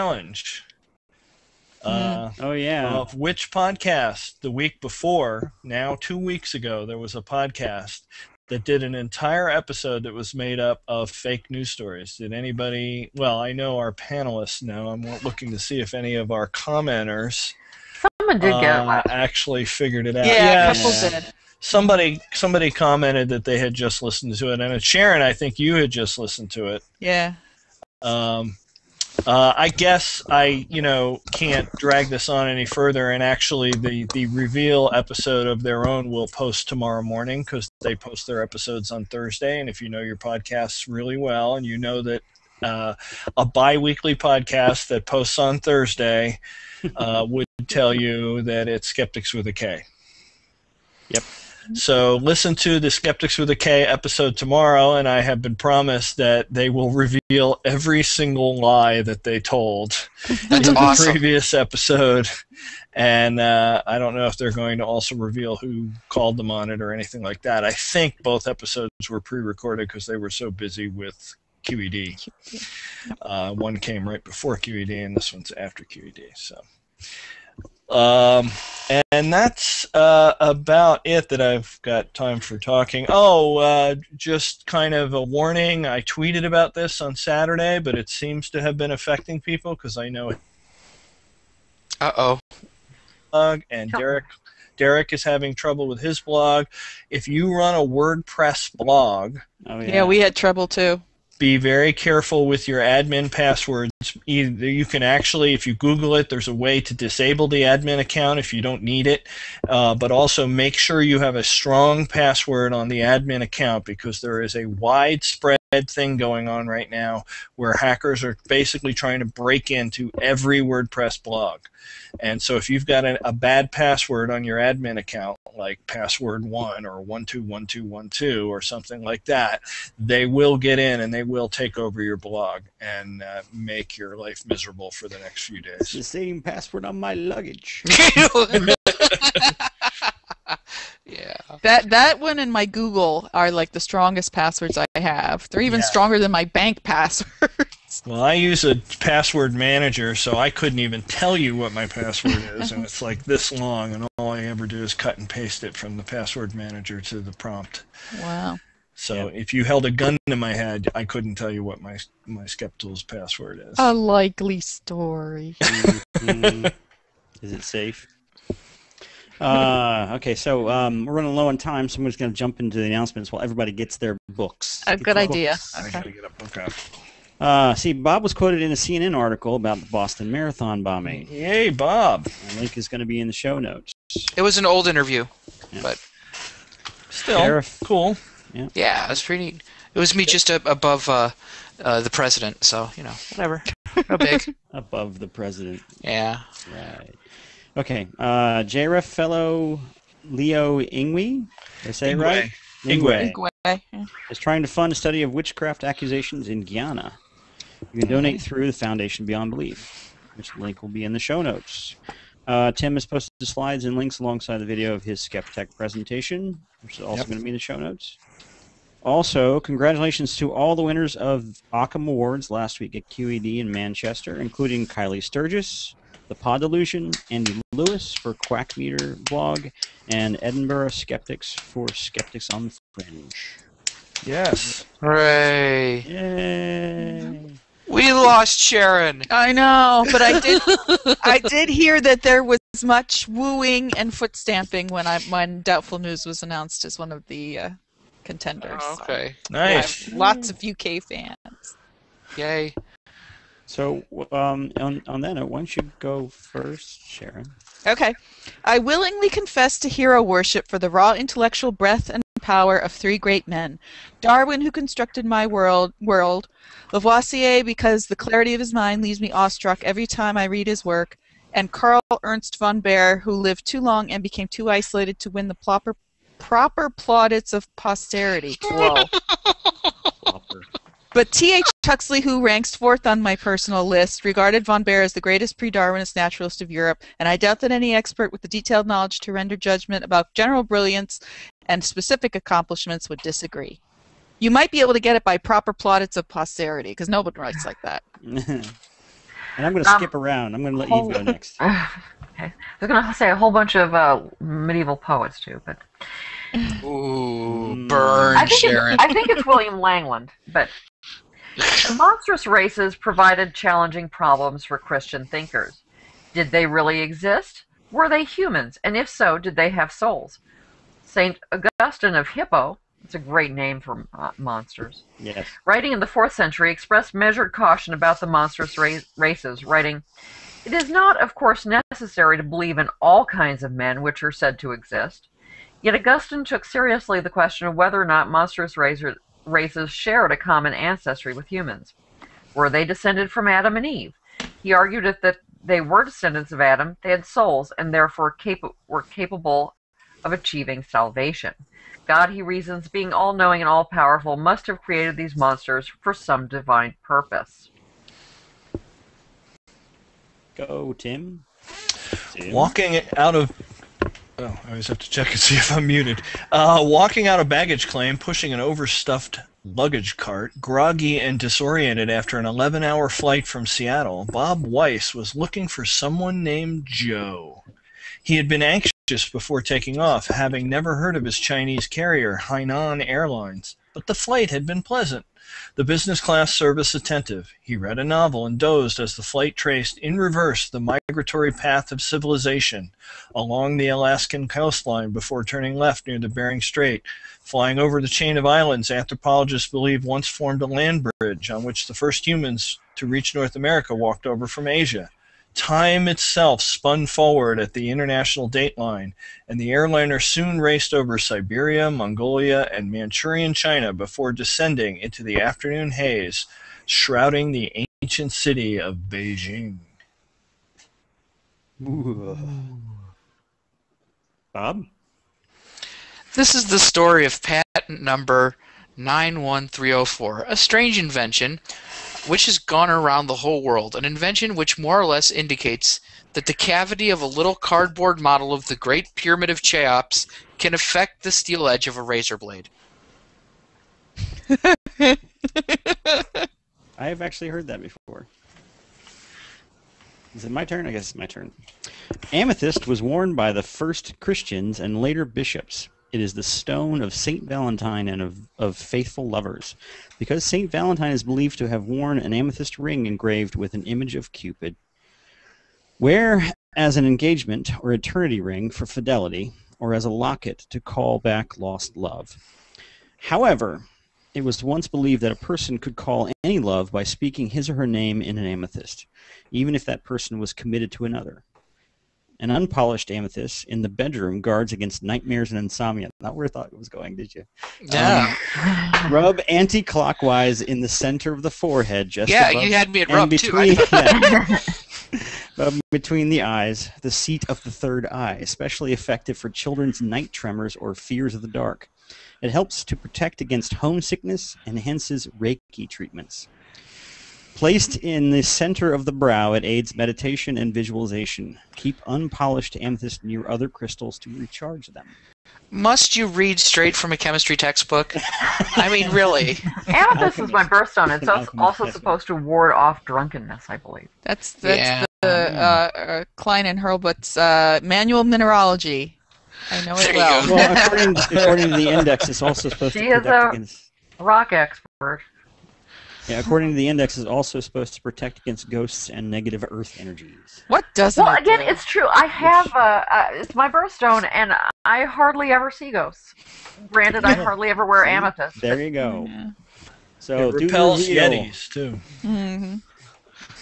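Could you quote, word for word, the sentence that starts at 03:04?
It was an old interview, yeah.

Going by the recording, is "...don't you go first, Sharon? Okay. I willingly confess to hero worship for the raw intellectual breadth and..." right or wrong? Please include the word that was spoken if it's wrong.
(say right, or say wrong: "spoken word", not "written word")
right.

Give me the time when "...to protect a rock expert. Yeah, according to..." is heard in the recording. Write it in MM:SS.
08:53.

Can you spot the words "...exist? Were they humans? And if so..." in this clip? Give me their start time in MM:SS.
05:17.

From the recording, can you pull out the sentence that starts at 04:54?
You might be able to get it by proper plaudits of posterity, because nobody writes like that.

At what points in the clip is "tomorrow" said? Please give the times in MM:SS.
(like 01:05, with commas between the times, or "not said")
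00:36, 00:54.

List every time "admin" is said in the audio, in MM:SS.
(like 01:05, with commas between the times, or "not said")
01:42, 01:47, 01:52, 02:04.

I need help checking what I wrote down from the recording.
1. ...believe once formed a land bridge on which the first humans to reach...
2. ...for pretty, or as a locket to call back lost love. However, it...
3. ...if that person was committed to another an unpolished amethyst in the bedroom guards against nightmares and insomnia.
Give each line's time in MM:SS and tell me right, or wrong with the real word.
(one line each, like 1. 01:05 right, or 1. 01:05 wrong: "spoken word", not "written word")
1. 06:39 right
2. 07:48 wrong: "fidelity", not "pretty"
3. 07:59 right.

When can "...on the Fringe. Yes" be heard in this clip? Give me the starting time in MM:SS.
03:52.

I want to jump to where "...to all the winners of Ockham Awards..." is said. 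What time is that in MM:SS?
03:40.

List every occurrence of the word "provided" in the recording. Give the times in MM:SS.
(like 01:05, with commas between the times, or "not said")
05:12.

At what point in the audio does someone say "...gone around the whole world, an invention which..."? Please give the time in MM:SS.
07:12.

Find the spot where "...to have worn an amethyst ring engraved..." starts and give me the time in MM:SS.
07:41.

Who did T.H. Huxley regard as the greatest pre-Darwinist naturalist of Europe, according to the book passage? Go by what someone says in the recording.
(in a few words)
Karl Ernst von Baer.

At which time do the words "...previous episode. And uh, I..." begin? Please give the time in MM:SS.
01:01.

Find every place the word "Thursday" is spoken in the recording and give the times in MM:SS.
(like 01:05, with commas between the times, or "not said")
00:39, 00:45.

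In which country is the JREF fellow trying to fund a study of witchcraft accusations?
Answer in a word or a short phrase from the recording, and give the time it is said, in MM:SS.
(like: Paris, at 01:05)
Guyana, at 03:26.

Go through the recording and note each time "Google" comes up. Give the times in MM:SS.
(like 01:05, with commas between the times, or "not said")
01:45, 02:22.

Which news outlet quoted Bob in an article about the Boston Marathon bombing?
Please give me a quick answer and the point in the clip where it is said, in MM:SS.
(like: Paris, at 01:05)
CNN, at 02:58.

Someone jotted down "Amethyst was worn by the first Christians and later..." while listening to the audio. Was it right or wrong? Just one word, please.
right.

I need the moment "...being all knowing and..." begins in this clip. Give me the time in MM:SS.
05:52.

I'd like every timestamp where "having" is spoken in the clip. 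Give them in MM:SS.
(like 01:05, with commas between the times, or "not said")
01:35, 06:20.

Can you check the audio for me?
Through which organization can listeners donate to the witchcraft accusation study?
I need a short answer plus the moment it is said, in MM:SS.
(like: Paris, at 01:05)
Foundation Beyond Belief, at 03:28.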